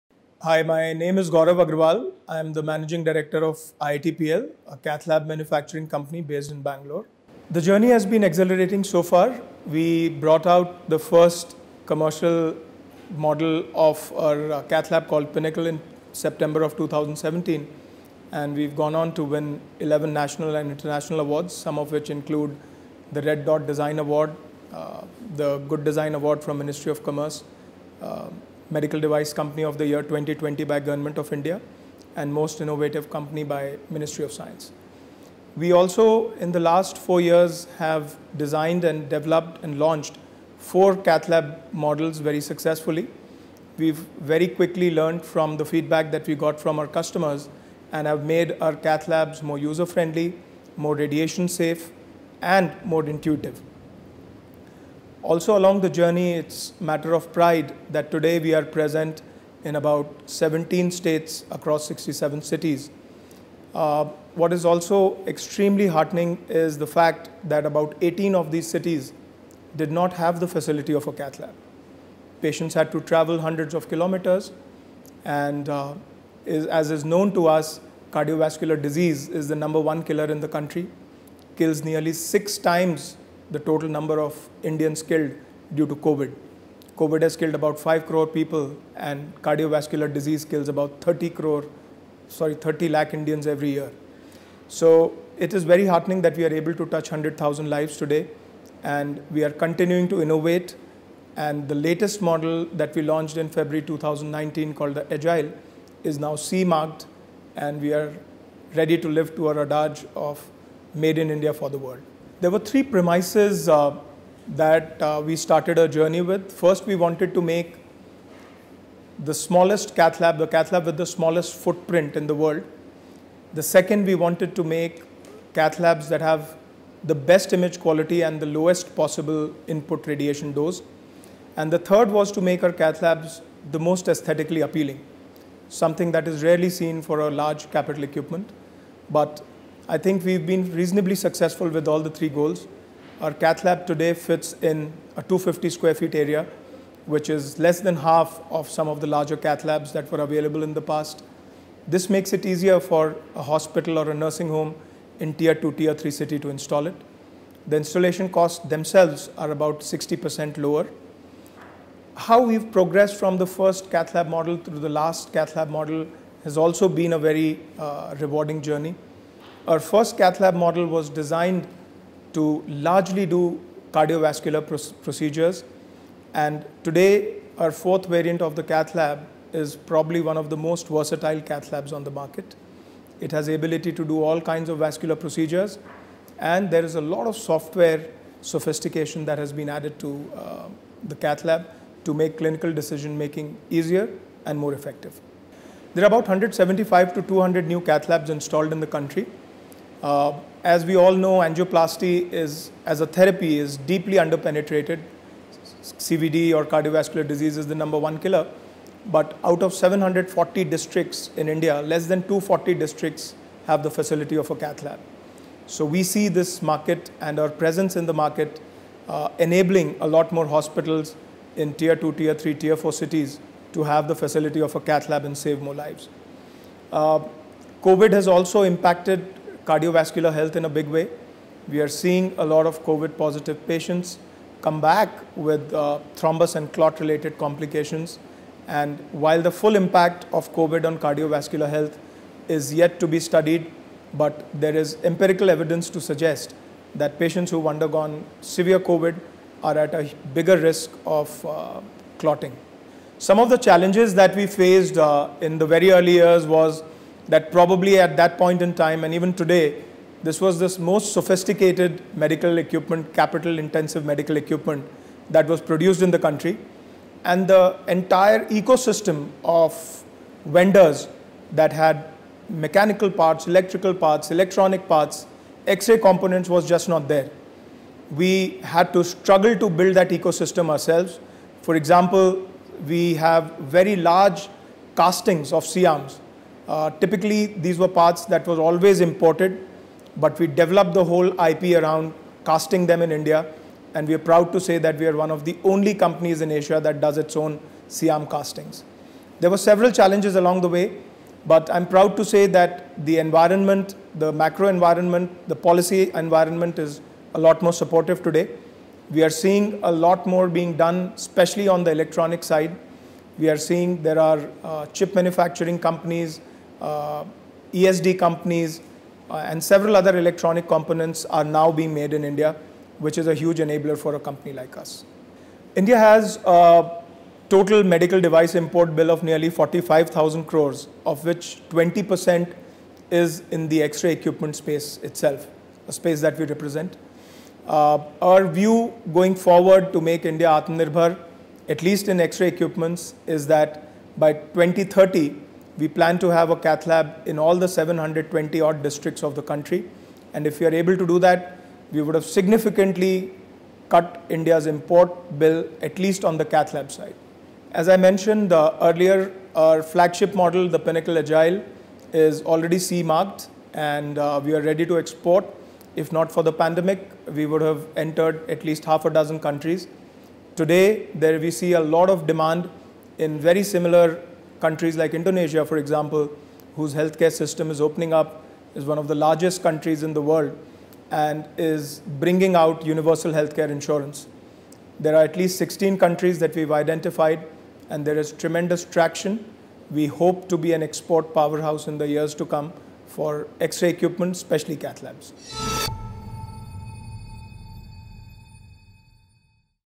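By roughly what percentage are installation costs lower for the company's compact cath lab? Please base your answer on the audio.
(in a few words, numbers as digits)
60%.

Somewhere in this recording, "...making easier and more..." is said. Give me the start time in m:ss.
3:13.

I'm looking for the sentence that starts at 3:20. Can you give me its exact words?
Uh, as we all know, angioplasty is, as a therapy is deeply underpenetrated.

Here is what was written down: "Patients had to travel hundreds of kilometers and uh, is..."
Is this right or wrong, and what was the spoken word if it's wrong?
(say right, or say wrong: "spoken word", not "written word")
right.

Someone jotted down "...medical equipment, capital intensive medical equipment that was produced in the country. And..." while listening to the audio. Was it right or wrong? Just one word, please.
right.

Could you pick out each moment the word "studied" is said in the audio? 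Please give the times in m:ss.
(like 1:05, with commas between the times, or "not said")
4:03.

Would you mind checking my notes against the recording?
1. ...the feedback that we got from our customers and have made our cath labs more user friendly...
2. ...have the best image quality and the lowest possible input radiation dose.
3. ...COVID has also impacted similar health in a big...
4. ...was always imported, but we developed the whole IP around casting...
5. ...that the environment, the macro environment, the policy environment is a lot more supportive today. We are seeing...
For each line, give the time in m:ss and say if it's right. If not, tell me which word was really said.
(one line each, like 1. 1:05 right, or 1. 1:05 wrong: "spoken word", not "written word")
1. 0:45 right
2. 2:06 right
3. 3:47 wrong: "cardiovascular", not "similar"
4. 4:48 right
5. 5:02 right.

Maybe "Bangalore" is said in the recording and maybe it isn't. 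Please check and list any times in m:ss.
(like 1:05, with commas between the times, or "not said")
0:06.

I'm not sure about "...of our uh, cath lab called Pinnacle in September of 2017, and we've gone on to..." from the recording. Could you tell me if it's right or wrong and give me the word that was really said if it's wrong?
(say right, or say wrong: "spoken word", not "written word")
right.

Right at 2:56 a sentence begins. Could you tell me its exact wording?
And today, our fourth variant of the cath lab is probably one of the most versatile cath labs on the market.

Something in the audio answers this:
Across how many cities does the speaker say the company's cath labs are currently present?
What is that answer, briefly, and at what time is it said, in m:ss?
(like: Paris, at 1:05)
67, at 1:01.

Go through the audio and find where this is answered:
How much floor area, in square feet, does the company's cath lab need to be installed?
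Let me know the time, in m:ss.
2:25.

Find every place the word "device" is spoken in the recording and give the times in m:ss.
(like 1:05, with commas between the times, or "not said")
0:29, 5:28.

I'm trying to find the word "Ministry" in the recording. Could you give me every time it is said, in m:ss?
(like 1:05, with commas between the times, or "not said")
0:26, 0:33.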